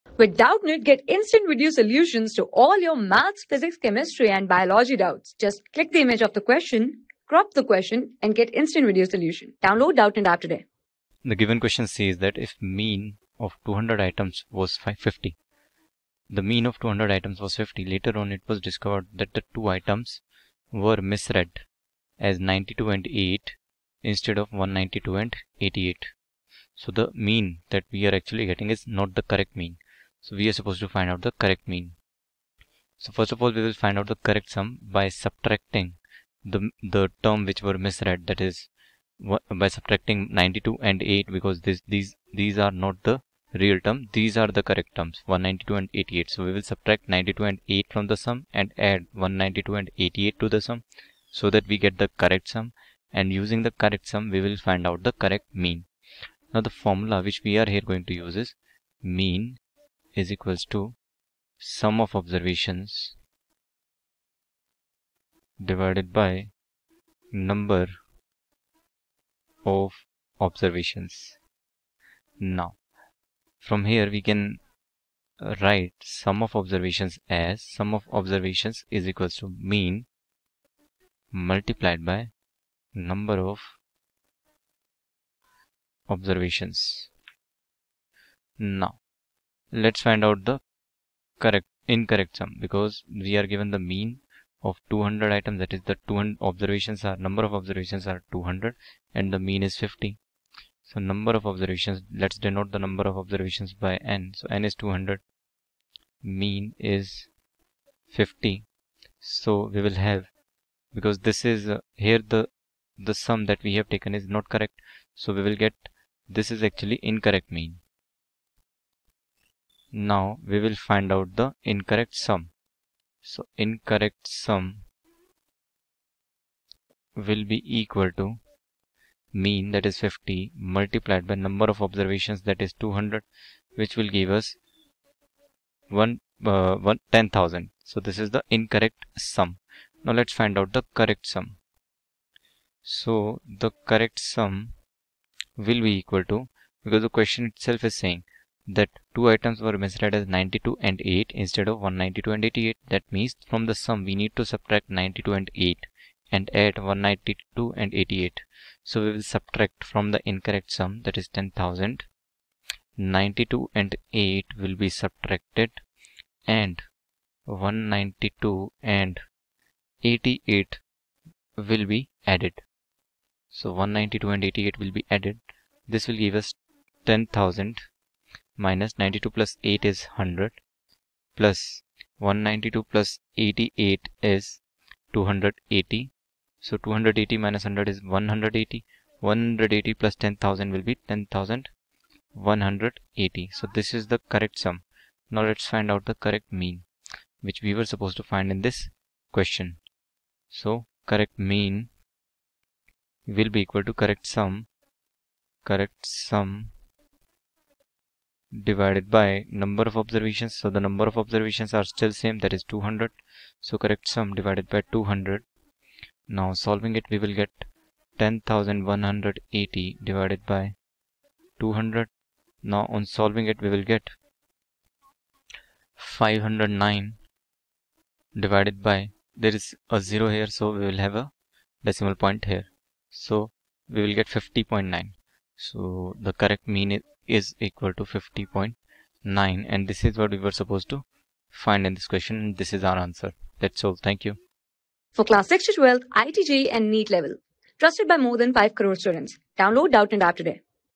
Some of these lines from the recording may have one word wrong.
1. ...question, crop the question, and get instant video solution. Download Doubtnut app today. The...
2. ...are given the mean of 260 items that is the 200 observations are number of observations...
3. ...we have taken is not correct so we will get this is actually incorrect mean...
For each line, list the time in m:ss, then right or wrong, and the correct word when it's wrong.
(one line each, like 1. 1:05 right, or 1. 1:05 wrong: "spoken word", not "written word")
1. 0:06 right
2. 1:33 wrong: "200", not "260"
3. 1:53 right.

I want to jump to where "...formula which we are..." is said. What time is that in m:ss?
0:56.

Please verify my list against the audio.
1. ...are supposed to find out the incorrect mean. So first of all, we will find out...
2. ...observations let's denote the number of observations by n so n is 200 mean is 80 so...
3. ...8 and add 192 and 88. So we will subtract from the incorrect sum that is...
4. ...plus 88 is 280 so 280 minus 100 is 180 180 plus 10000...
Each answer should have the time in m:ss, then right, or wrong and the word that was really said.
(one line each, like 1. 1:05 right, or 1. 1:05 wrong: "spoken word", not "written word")
1. 0:30 wrong: "correct", not "incorrect"
2. 1:41 wrong: "50", not "80"
3. 2:35 right
4. 3:02 right.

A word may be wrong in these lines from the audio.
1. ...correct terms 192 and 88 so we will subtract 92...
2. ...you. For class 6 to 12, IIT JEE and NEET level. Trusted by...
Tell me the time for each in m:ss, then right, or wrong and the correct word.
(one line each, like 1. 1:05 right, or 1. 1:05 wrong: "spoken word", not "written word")
1. 0:44 right
2. 4:04 right.